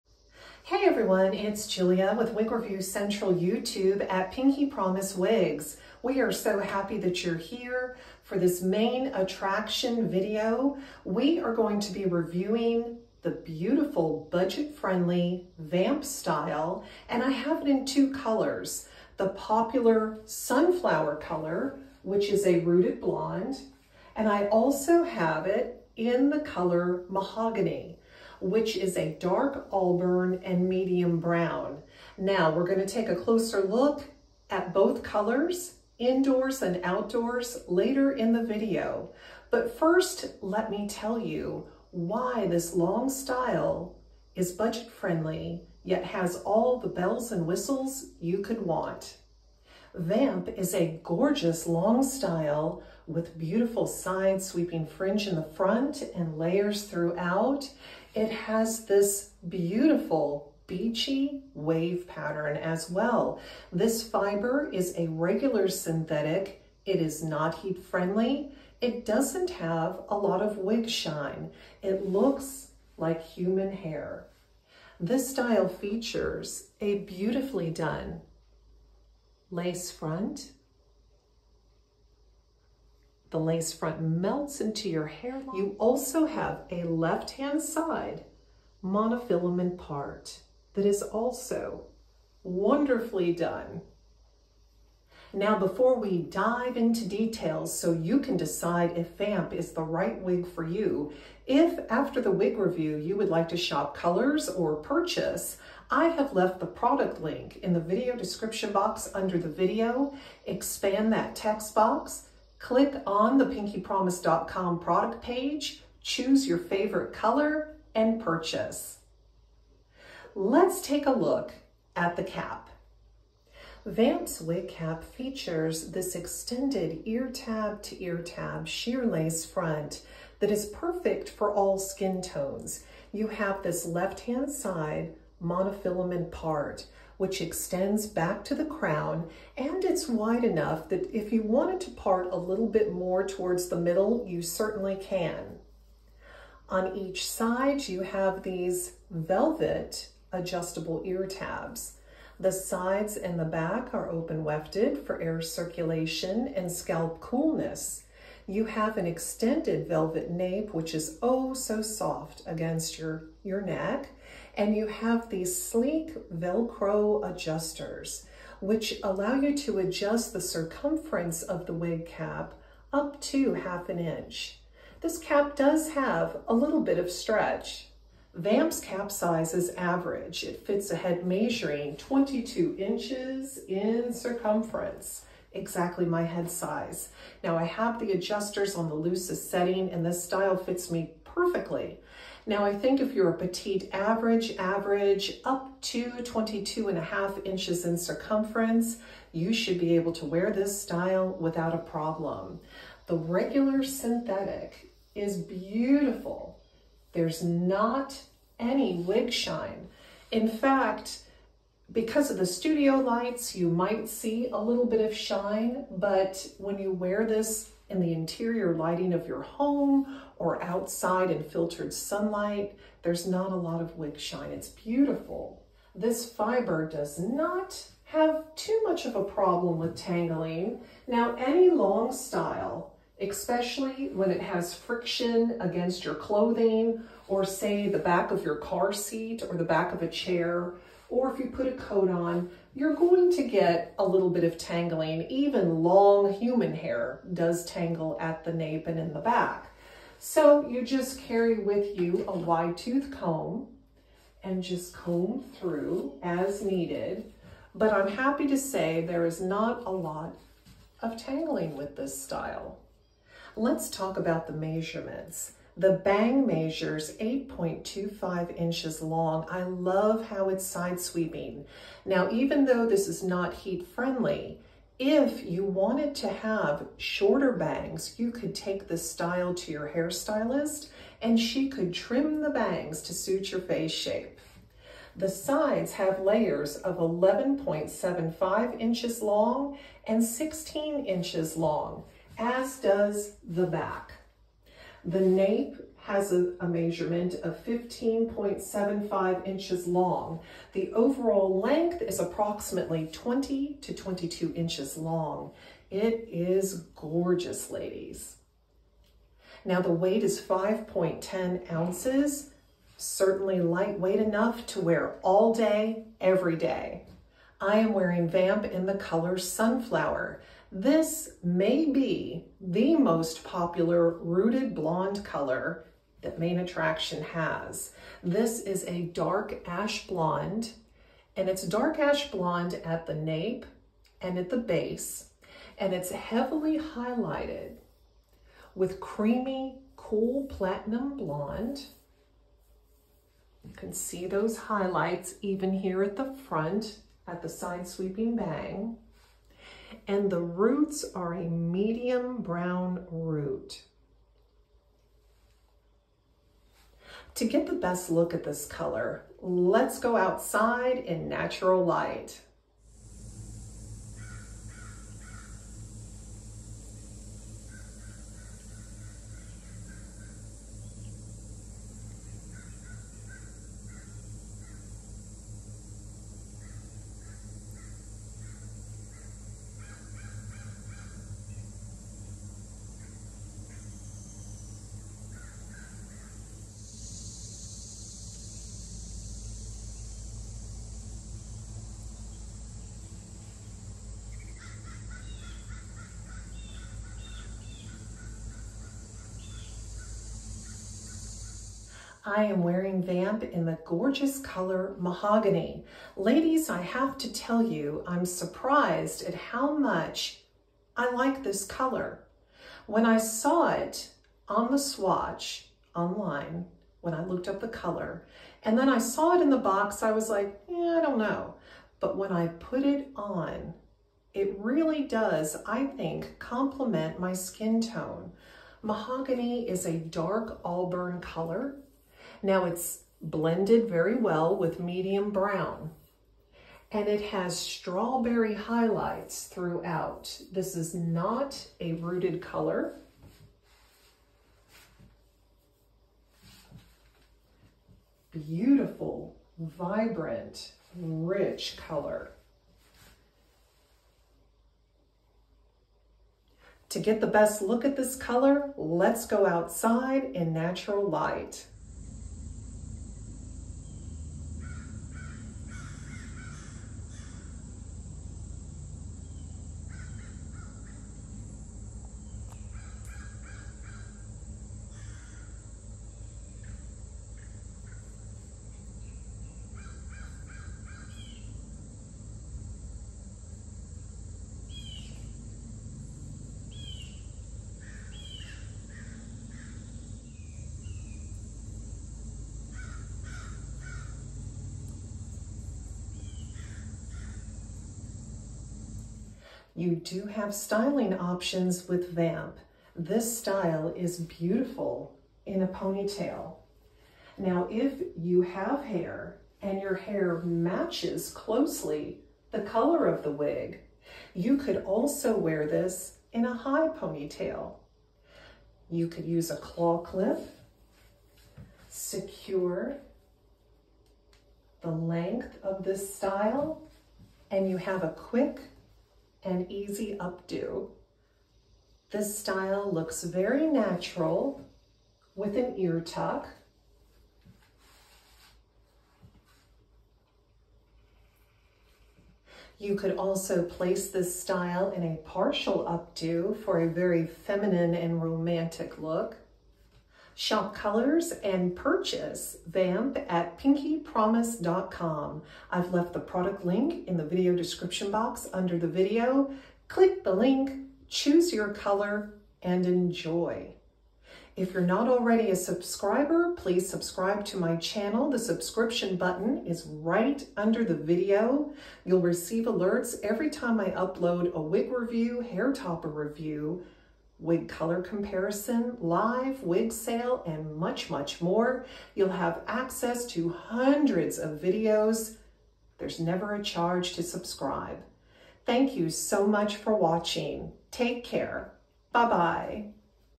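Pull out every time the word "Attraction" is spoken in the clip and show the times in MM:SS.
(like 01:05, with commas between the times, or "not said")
00:09, 05:26.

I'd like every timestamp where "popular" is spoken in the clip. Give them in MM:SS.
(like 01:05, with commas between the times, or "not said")
00:19, 05:23.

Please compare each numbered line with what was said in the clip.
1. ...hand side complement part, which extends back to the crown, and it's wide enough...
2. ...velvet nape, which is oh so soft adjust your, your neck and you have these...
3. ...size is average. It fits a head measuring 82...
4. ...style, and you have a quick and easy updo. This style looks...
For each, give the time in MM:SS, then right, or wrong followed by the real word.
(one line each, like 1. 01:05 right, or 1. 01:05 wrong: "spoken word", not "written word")
1. 02:14 wrong: "monofilament", not "complement"
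2. 02:39 wrong: "against", not "adjust"
3. 02:59 wrong: "22", not "82"
4. 08:46 right.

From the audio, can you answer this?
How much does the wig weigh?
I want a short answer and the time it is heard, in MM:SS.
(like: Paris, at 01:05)
5.10 ounces, at 05:10.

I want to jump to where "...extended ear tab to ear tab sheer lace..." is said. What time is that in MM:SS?
02:06.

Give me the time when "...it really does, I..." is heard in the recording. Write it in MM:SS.
07:04.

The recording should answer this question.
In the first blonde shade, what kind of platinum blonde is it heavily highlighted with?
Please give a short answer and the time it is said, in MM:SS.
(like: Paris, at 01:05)
creamy, cool platinum blonde, at 05:39.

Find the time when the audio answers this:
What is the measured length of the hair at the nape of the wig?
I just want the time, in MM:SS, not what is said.
04:57.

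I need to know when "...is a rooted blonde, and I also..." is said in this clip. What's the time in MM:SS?
00:22.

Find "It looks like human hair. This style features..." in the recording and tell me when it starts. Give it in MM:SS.
01:11.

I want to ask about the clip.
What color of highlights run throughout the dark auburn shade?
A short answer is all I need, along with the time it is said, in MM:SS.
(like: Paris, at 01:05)
strawberry, at 07:17.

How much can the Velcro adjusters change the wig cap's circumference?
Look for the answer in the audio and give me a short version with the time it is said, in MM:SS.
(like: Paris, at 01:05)
half an inch, at 02:53.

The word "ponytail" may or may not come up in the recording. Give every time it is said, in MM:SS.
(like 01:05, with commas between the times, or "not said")
08:25, 08:36.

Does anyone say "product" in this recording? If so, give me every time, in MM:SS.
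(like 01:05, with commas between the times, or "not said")
01:46, 01:54, 09:16.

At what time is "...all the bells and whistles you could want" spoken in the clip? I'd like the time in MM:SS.
00:46.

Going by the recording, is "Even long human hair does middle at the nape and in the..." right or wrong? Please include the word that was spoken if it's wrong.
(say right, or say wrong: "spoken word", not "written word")
wrong: "tangle", not "middle".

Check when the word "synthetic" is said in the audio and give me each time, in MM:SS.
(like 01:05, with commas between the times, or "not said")
01:05, 03:23.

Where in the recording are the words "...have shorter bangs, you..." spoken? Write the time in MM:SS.
04:36.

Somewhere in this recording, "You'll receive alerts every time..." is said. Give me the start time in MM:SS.
09:32.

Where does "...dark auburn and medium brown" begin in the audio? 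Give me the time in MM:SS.
00:29.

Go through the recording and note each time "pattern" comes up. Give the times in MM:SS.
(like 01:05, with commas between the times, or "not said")
01:02.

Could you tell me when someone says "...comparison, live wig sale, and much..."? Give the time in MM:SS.
09:38.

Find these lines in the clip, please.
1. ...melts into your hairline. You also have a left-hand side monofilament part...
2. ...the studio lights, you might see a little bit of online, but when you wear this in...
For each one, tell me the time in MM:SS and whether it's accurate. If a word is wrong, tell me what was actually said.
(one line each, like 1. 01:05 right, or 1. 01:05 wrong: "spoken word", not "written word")
1. 01:24 right
2. 03:32 wrong: "shine", not "online".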